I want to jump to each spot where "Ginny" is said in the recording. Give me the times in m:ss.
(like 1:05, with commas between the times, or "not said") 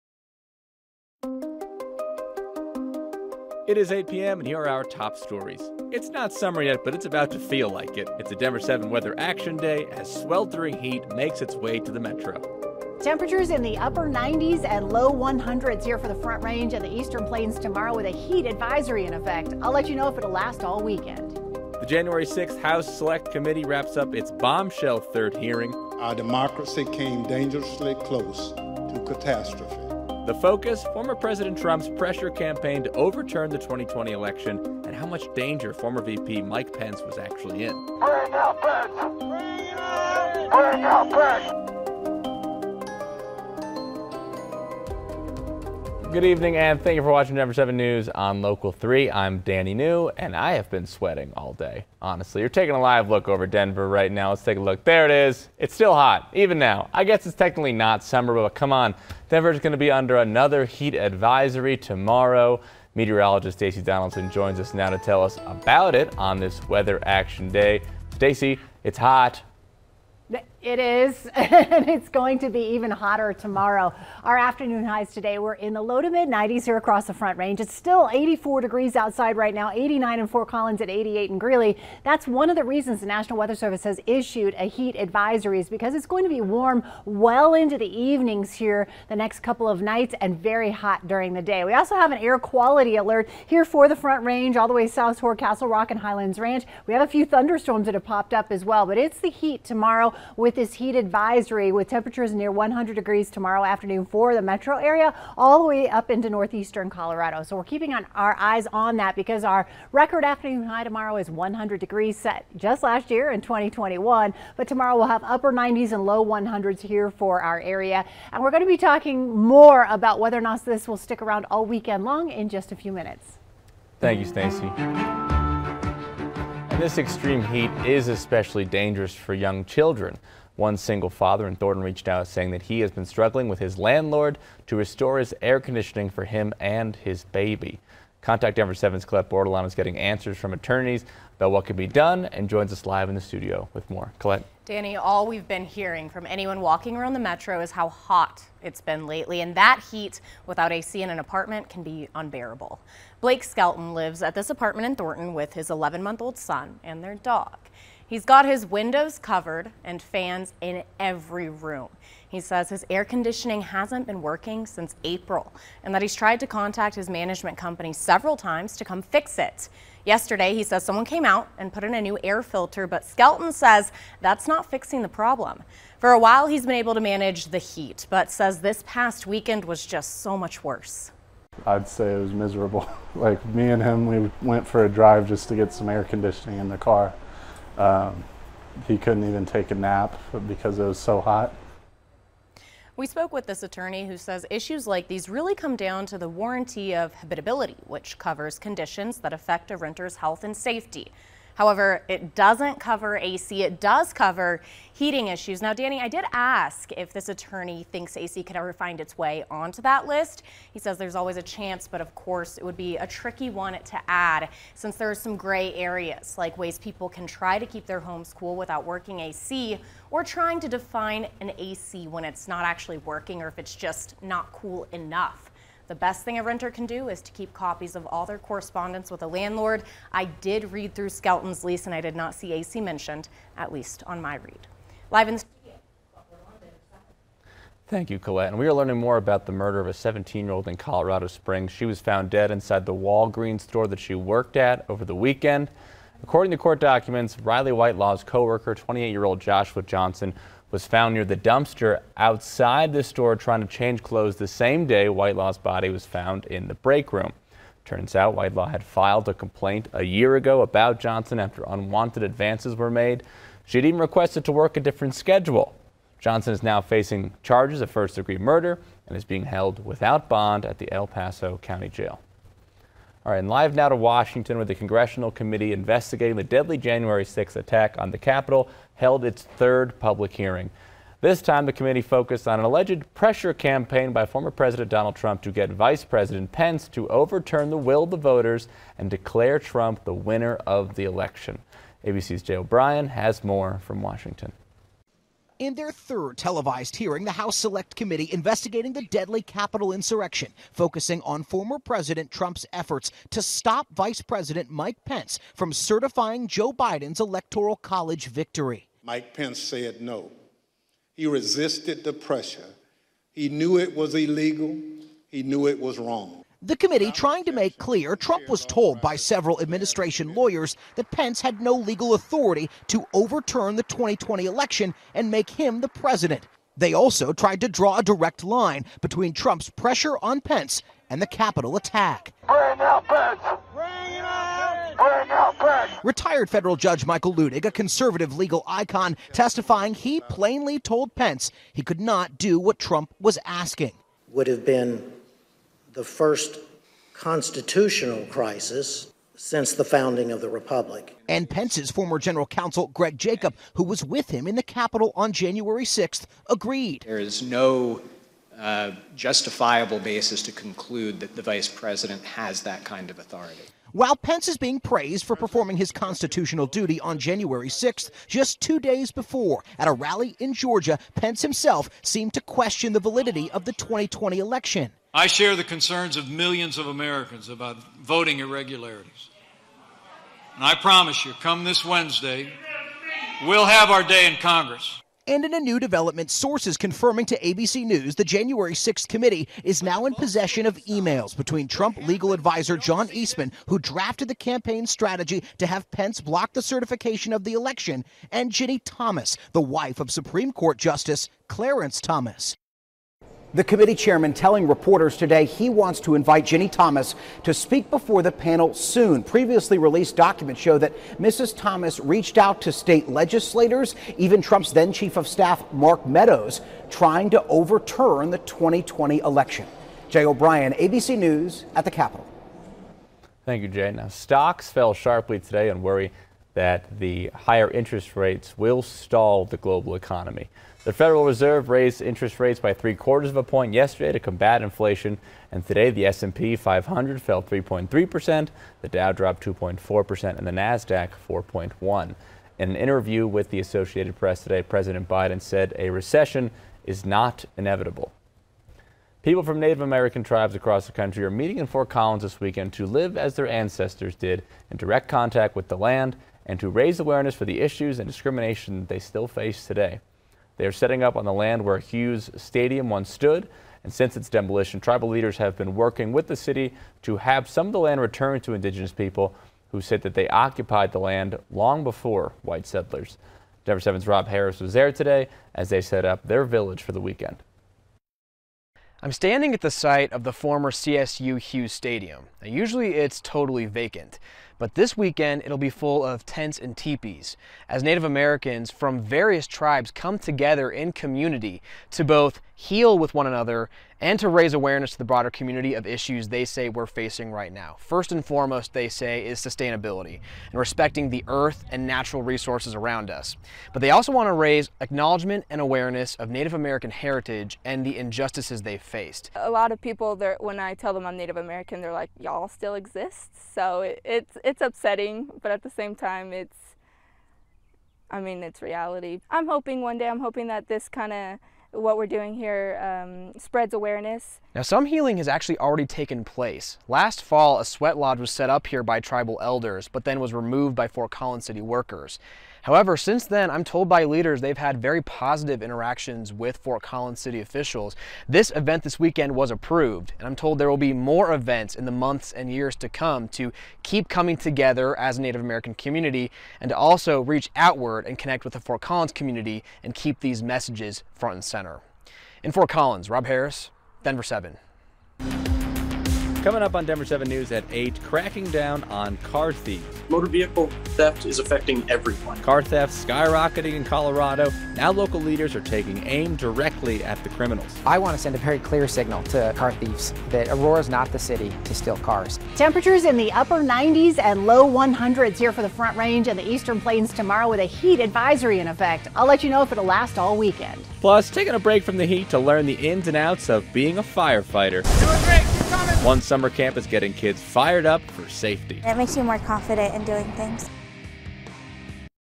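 6:38, 6:46.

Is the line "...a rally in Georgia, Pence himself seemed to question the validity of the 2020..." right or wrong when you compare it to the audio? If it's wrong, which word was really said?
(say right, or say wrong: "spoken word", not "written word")
right.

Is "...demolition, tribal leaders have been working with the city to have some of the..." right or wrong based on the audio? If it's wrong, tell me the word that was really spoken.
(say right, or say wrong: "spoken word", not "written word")
right.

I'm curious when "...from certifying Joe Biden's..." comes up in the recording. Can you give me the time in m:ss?
5:05.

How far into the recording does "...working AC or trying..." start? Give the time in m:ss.
3:38.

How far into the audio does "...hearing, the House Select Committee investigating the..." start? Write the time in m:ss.
4:56.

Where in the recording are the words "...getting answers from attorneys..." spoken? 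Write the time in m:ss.
2:19.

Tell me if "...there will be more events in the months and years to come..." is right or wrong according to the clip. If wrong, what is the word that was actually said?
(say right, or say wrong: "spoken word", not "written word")
right.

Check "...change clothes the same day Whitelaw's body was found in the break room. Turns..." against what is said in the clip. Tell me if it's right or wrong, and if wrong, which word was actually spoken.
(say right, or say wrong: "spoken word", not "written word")
right.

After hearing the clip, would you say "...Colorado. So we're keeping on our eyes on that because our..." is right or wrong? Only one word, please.
right.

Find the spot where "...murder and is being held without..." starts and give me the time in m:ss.
4:28.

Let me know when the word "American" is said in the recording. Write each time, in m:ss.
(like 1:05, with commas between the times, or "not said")
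6:16, 7:29, 8:08, 8:26, 8:31, 9:05.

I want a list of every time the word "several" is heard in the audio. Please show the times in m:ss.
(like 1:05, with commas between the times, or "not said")
2:47, 5:19.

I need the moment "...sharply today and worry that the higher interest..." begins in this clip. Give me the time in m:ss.
7:04.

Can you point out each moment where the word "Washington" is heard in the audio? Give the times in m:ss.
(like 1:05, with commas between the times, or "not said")
4:33, 4:54.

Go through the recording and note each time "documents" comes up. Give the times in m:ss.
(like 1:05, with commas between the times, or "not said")
4:06, 6:50.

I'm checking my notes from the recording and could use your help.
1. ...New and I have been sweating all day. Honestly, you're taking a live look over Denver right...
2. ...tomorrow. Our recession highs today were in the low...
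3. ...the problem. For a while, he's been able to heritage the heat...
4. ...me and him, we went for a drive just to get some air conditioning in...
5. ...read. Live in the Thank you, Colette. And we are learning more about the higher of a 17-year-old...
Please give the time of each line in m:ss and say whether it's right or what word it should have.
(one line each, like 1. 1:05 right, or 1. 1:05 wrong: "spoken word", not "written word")
1. 0:49 right
2. 1:13 wrong: "afternoon", not "recession"
3. 2:55 wrong: "manage", not "heritage"
4. 3:03 right
5. 3:54 wrong: "murder", not "higher".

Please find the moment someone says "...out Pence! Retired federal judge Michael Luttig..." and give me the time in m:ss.
5:35.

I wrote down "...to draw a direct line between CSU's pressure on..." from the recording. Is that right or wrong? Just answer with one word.
wrong.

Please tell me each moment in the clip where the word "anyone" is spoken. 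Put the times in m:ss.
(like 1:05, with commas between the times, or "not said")
2:26.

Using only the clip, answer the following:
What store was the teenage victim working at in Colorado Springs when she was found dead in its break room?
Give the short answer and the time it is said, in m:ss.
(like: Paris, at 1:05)
Walgreens, at 4:02.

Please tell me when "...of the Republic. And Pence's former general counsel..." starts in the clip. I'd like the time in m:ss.
5:50.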